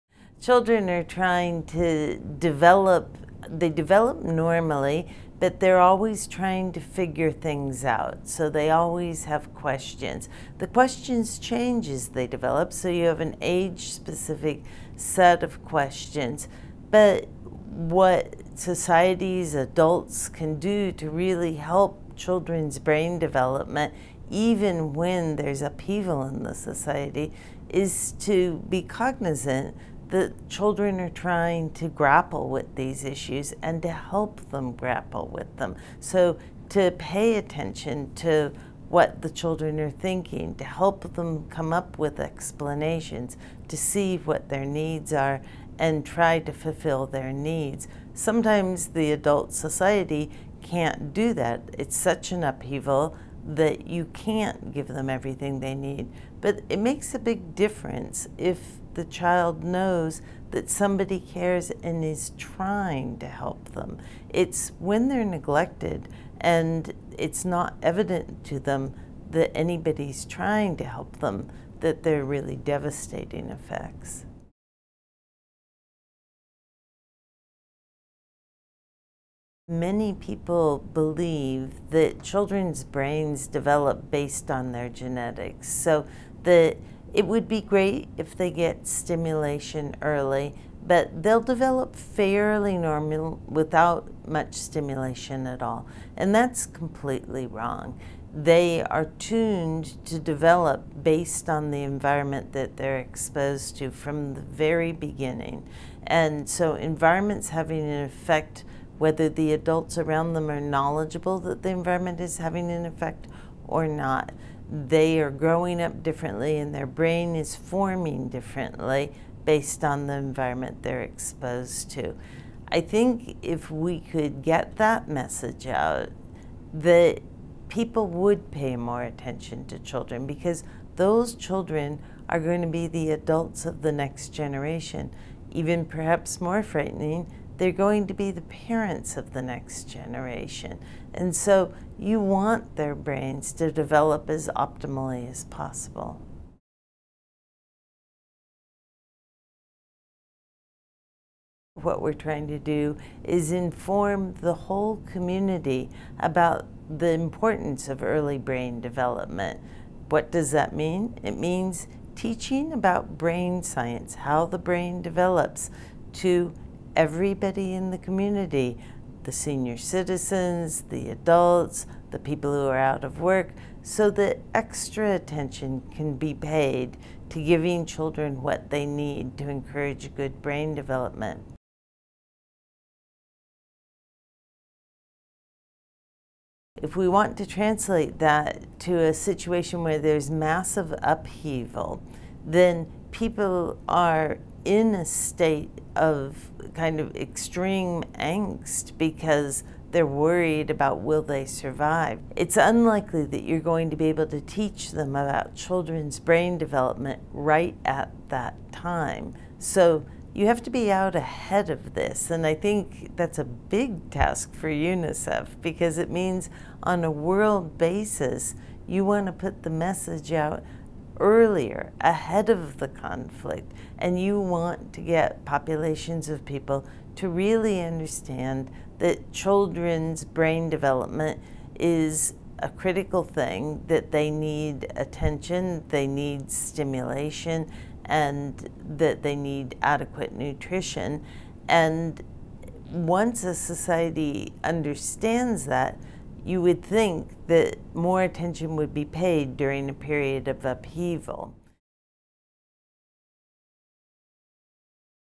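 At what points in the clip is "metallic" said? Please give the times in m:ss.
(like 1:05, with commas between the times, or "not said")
not said.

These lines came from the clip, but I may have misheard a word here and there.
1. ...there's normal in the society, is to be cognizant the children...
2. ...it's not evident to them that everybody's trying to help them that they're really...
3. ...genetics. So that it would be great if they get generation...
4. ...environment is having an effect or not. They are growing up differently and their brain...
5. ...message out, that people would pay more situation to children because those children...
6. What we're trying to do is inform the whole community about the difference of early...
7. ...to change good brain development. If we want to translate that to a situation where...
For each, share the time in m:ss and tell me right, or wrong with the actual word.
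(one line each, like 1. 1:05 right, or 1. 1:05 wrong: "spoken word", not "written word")
1. 0:25 wrong: "upheaval", not "normal"
2. 1:07 wrong: "anybody", not "everybody"
3. 1:24 wrong: "stimulation", not "generation"
4. 1:51 right
5. 2:05 wrong: "attention", not "situation"
6. 2:31 wrong: "importance", not "difference"
7. 2:59 wrong: "encourage", not "change".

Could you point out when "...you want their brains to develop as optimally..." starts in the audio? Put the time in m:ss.
2:21.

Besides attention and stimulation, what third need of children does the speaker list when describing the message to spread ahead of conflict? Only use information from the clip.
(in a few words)
Adequate nutrition.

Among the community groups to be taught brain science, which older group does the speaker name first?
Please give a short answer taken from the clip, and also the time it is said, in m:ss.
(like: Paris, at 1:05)
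Senior citizens, at 2:49.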